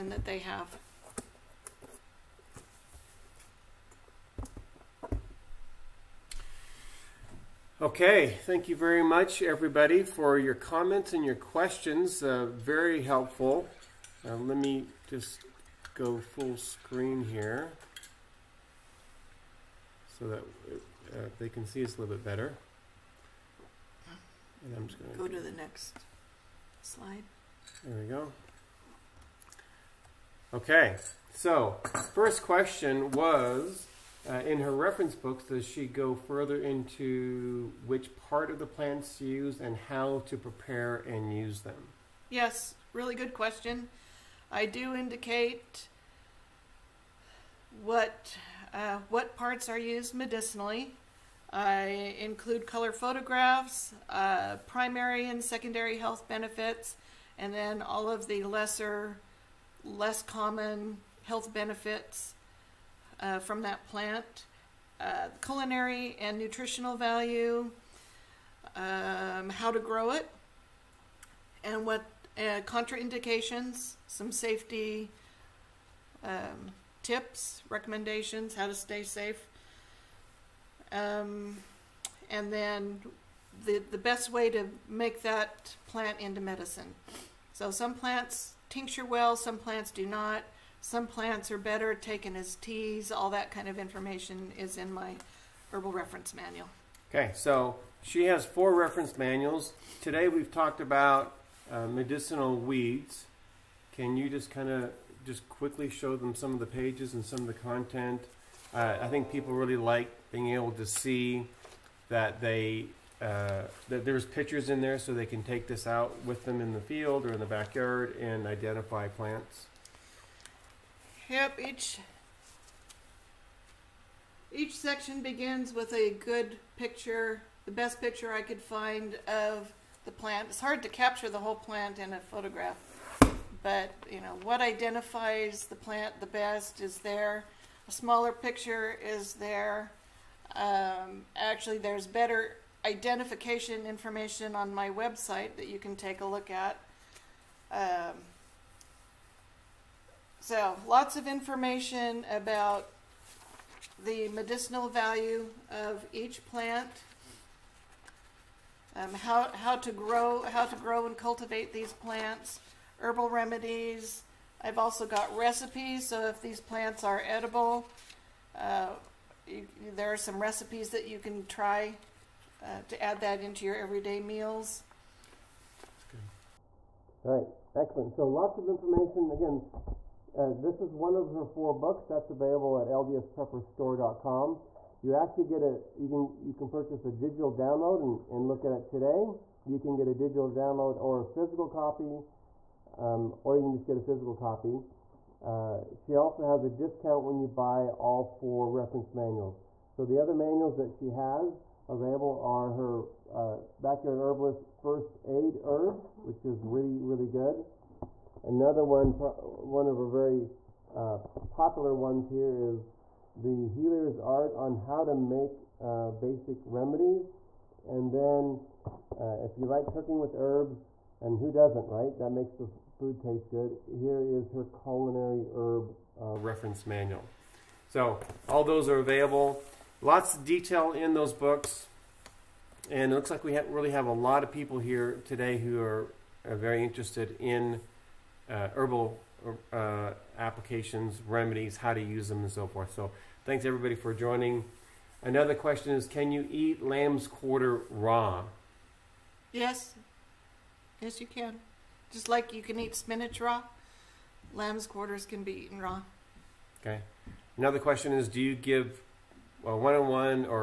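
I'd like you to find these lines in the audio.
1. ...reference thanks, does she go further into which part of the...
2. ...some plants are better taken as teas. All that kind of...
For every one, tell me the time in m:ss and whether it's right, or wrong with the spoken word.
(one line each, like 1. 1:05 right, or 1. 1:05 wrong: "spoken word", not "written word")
1. 0:34 wrong: "books", not "thanks"
2. 1:30 right.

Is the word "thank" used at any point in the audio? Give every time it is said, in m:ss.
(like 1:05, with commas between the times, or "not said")
0:08, 4:03.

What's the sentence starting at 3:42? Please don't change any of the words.
That makes the food taste good.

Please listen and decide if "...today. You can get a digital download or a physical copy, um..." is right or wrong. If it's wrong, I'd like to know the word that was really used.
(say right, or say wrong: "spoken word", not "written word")
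right.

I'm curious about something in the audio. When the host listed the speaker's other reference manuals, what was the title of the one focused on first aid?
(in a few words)
Backyard Herbalist First Aid Herbs.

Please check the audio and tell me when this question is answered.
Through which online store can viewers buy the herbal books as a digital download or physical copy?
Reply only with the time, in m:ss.
3:02.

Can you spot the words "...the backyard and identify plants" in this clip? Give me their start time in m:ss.
1:57.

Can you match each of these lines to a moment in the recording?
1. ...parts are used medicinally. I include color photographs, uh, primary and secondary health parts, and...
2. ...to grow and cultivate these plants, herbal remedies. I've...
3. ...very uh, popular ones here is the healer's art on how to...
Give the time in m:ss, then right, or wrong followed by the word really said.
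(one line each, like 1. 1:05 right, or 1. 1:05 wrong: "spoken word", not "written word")
1. 0:49 wrong: "benefits", not "parts"
2. 2:40 right
3. 3:30 right.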